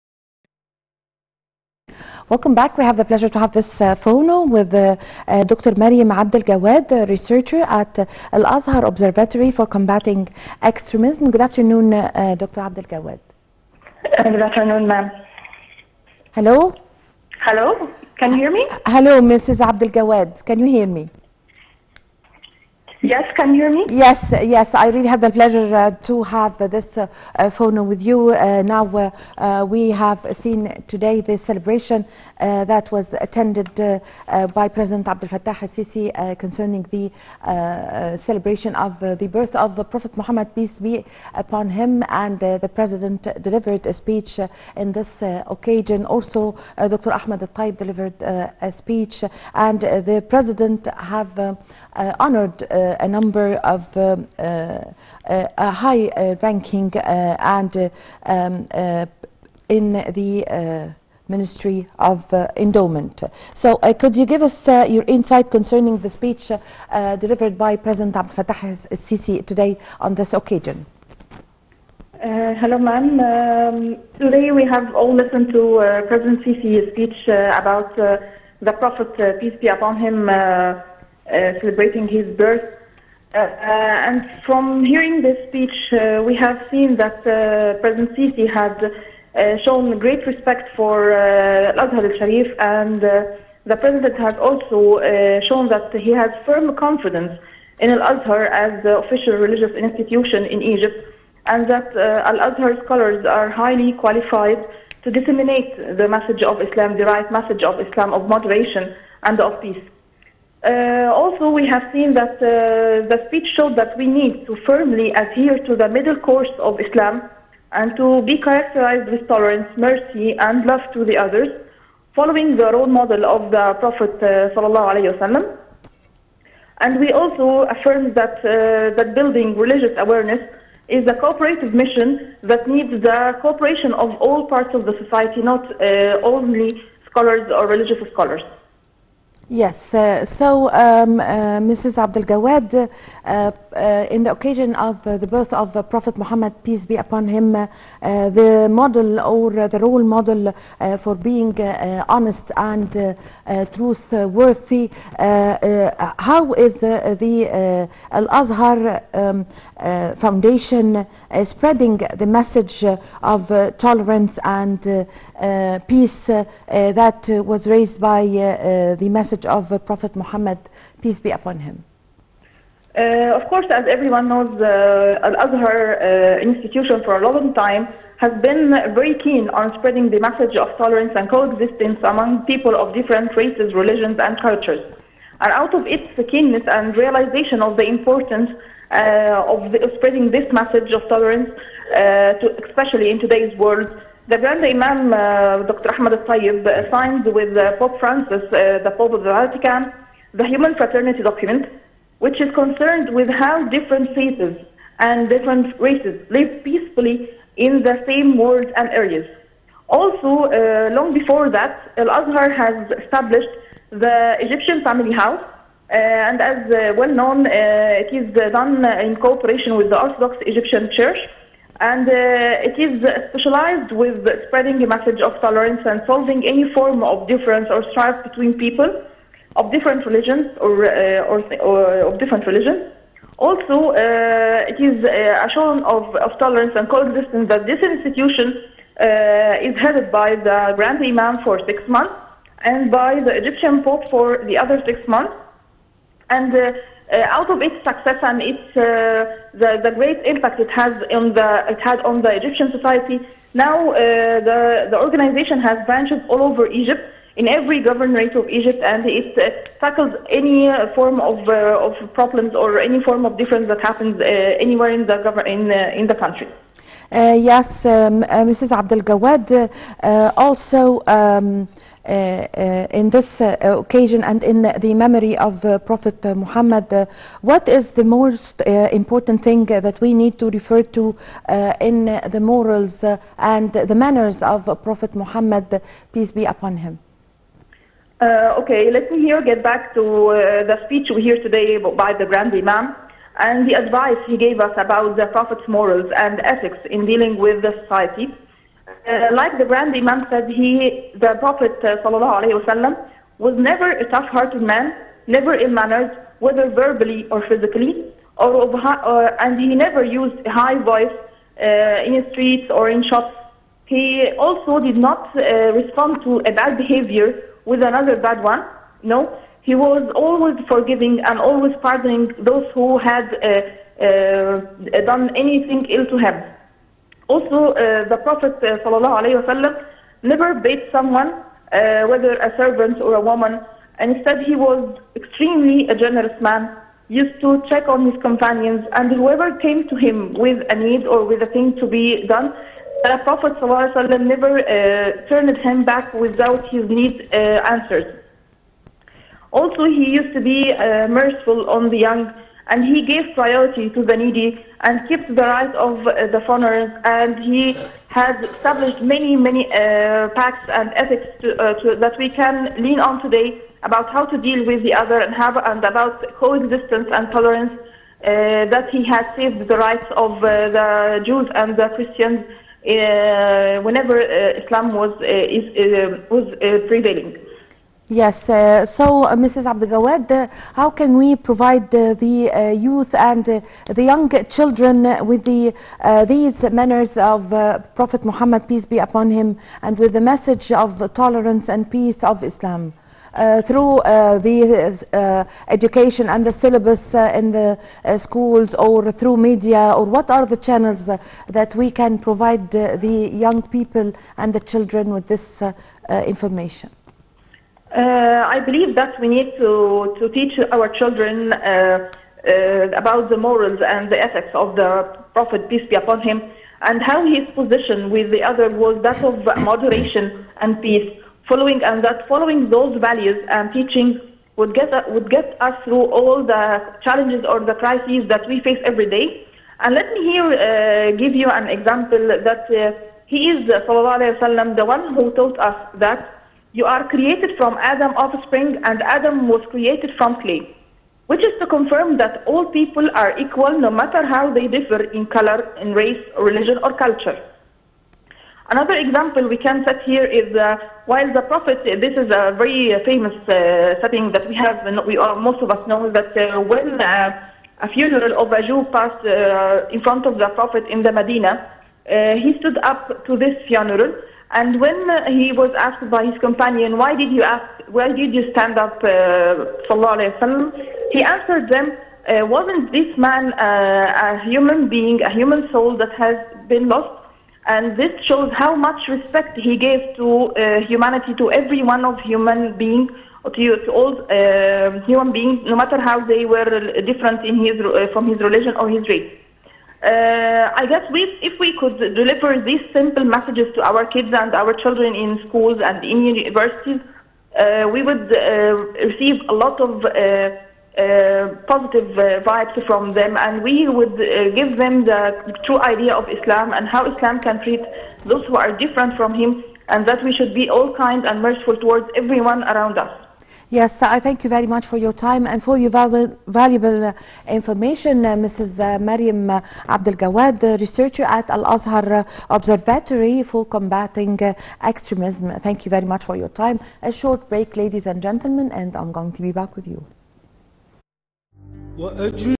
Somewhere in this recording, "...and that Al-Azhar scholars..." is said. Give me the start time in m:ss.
1:41.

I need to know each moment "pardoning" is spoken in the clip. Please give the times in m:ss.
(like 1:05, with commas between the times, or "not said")
5:21.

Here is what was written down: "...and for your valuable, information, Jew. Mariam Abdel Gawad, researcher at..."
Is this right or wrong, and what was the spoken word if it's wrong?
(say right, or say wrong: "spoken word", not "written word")
wrong: "Mrs", not "Jew".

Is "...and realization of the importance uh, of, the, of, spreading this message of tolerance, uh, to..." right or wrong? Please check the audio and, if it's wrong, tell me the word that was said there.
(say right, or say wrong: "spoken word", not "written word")
right.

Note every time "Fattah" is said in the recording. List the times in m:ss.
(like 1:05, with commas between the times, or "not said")
0:35, 1:08.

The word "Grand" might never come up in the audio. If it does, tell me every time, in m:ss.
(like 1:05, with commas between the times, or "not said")
3:14, 4:00, 4:52, 4:59.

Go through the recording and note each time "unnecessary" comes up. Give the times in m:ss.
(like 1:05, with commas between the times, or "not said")
not said.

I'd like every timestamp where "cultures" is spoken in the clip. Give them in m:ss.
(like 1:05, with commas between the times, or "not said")
3:04, 7:27.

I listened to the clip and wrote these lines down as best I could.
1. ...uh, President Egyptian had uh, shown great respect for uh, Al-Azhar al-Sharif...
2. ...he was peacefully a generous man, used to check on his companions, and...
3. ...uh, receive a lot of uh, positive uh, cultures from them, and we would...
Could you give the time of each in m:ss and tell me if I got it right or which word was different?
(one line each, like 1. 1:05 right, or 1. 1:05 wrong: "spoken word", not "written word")
1. 1:27 wrong: "Sisi", not "Egyptian"
2. 5:34 wrong: "extremely", not "peacefully"
3. 8:18 wrong: "vibes", not "cultures".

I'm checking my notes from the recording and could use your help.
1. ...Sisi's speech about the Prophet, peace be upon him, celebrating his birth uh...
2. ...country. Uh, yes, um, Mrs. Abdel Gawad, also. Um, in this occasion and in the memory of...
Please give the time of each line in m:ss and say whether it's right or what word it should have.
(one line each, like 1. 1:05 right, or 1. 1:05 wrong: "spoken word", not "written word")
1. 1:16 right
2. 4:26 right.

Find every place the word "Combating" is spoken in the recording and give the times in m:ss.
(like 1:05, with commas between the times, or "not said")
0:09, 8:43.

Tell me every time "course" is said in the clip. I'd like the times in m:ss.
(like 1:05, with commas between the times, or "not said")
1:56, 2:53.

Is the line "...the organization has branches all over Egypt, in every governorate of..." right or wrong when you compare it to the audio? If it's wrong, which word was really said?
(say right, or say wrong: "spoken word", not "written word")
right.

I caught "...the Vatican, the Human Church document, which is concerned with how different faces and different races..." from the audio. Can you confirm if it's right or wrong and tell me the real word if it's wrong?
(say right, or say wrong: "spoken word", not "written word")
wrong: "Fraternity", not "Church".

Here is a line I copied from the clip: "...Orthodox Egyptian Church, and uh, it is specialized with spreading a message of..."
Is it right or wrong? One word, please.
right.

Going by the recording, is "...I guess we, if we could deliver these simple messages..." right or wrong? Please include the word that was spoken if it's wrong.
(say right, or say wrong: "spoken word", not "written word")
right.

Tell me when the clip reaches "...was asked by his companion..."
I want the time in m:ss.
7:45.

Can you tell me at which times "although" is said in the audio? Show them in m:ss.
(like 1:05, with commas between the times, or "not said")
not said.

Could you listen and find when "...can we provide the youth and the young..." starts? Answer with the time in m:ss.
6:20.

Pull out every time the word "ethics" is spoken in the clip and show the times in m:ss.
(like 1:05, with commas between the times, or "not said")
4:56, 6:00, 6:54.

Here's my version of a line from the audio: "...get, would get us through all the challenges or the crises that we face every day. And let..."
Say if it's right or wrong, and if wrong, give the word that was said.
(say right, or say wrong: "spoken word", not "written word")
right.